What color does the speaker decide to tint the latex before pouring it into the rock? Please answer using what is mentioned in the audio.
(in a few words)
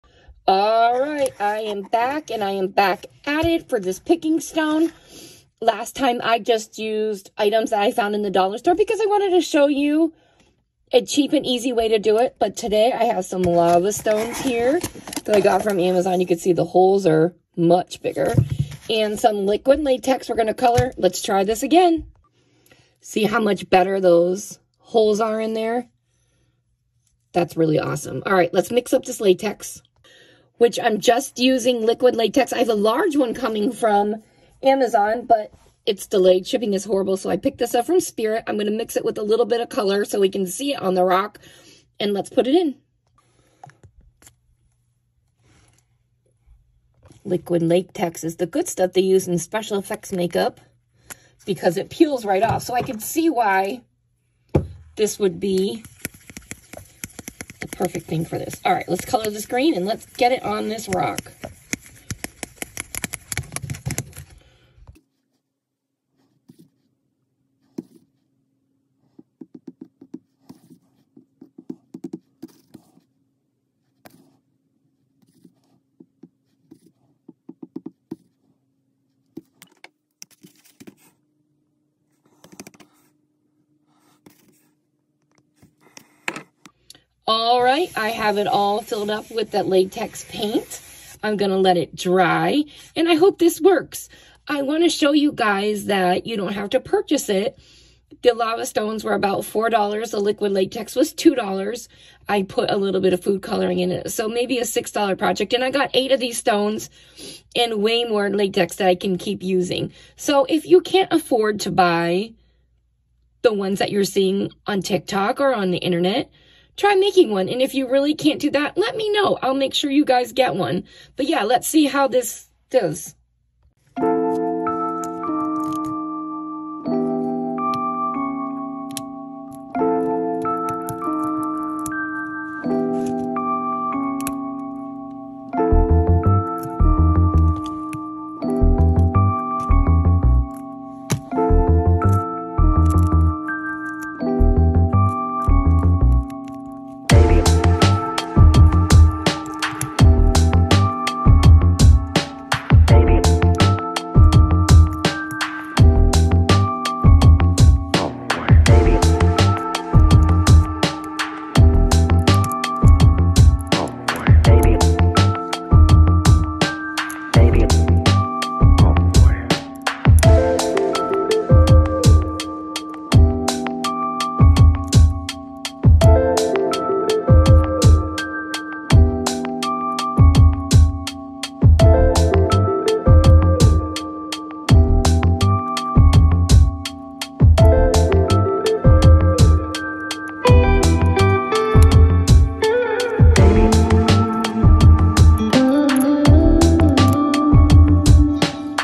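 green.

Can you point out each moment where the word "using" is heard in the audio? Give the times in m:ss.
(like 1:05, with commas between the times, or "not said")
0:31, 1:49.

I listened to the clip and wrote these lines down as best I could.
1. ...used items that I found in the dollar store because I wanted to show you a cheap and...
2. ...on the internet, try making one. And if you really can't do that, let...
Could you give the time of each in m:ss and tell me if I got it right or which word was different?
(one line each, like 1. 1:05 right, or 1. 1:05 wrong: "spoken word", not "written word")
1. 0:06 right
2. 1:55 right.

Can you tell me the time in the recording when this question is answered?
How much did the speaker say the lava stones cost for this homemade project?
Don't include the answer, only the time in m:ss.
1:39.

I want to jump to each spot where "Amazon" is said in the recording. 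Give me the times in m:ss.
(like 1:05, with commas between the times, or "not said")
0:15, 0:34.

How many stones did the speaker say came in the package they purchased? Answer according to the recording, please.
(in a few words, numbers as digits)
8.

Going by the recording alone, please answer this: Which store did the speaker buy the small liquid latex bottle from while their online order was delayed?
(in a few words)
Spirit.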